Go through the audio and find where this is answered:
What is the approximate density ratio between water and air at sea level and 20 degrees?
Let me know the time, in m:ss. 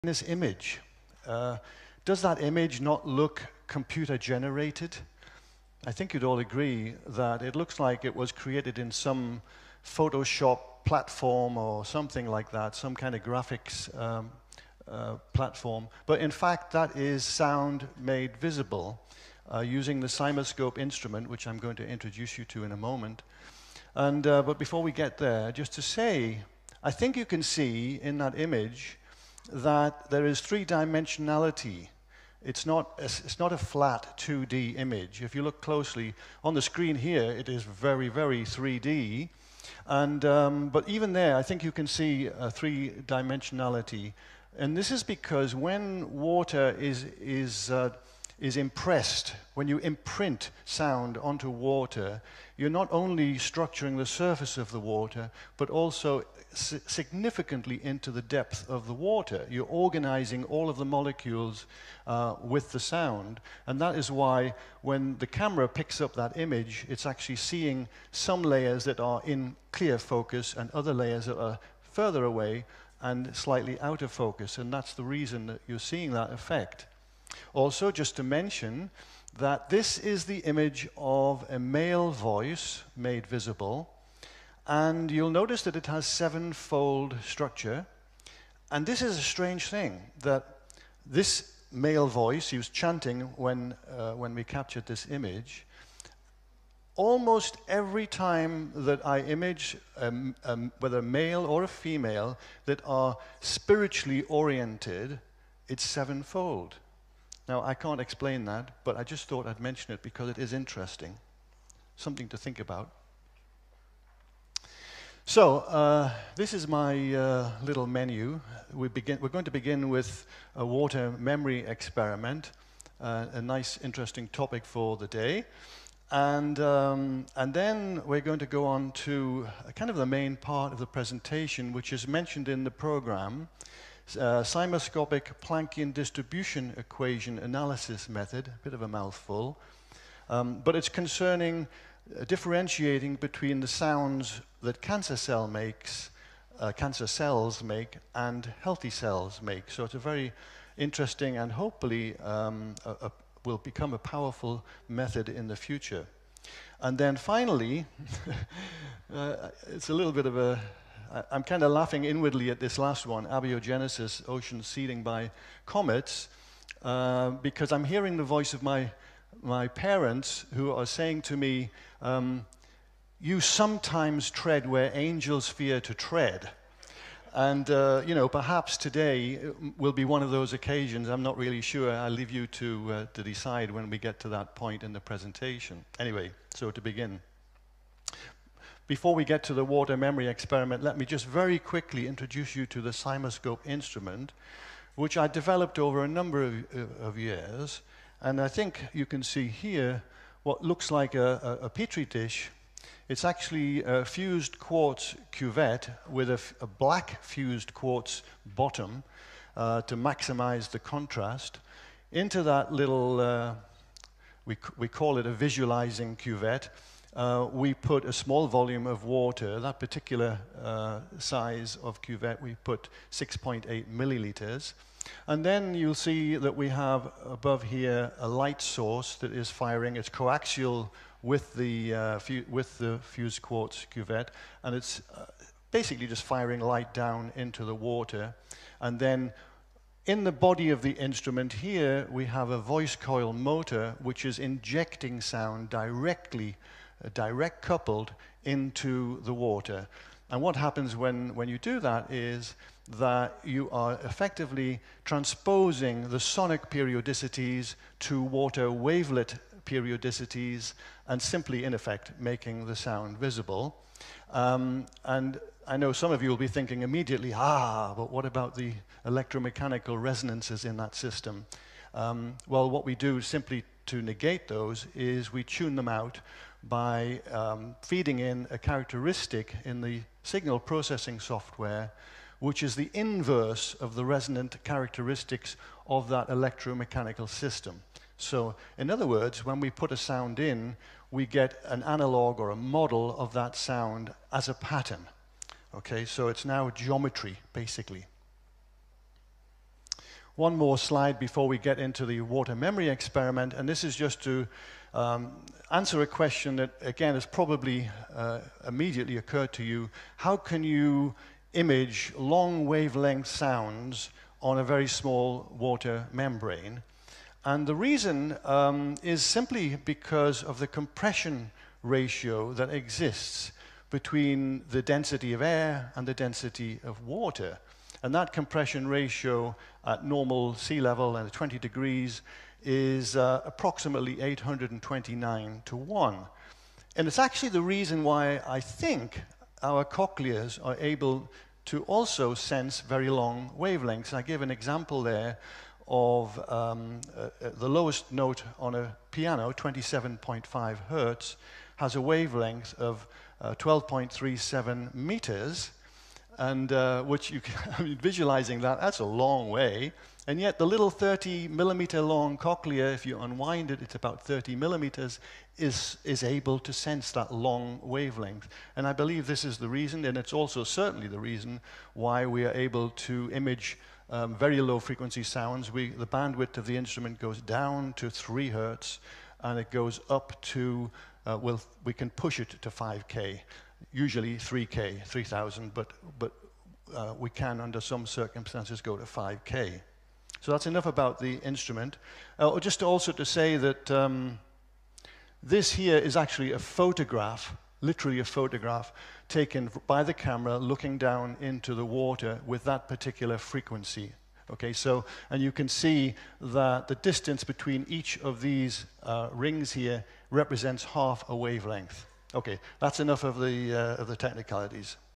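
5:34.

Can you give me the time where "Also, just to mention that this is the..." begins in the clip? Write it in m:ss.
1:17.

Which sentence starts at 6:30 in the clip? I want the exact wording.
So that's enough about the instrument.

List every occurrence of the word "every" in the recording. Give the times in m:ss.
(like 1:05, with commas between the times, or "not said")
1:37.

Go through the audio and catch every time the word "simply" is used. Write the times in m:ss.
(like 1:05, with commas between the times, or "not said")
4:21, 4:33, 5:19.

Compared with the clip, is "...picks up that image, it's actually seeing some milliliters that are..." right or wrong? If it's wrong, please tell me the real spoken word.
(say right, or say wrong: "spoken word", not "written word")
wrong: "layers", not "milliliters".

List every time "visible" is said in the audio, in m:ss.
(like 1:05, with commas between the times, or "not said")
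0:18, 1:23, 4:23.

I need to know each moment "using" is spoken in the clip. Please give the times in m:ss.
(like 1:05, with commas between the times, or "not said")
0:19.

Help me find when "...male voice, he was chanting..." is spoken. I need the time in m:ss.
1:31.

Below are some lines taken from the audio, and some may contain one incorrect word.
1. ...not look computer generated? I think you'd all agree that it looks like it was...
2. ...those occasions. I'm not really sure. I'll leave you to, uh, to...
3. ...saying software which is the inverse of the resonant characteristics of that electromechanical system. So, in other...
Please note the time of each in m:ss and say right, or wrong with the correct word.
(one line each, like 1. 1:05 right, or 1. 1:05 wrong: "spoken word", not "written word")
1. 0:02 right
2. 3:00 right
3. 4:40 wrong: "processing", not "saying".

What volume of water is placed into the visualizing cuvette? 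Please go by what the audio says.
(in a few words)
6.8 milliliters.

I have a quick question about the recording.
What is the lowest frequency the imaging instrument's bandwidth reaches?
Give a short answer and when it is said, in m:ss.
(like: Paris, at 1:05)
3 hertz, at 6:18.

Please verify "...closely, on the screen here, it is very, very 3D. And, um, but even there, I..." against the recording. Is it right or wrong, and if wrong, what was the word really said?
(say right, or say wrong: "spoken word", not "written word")
right.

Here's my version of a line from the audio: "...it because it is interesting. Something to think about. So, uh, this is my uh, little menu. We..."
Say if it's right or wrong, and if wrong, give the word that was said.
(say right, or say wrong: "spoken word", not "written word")
right.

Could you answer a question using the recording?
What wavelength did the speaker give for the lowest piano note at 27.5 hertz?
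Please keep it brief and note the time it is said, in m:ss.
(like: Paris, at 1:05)
12.37 meters, at 5:53.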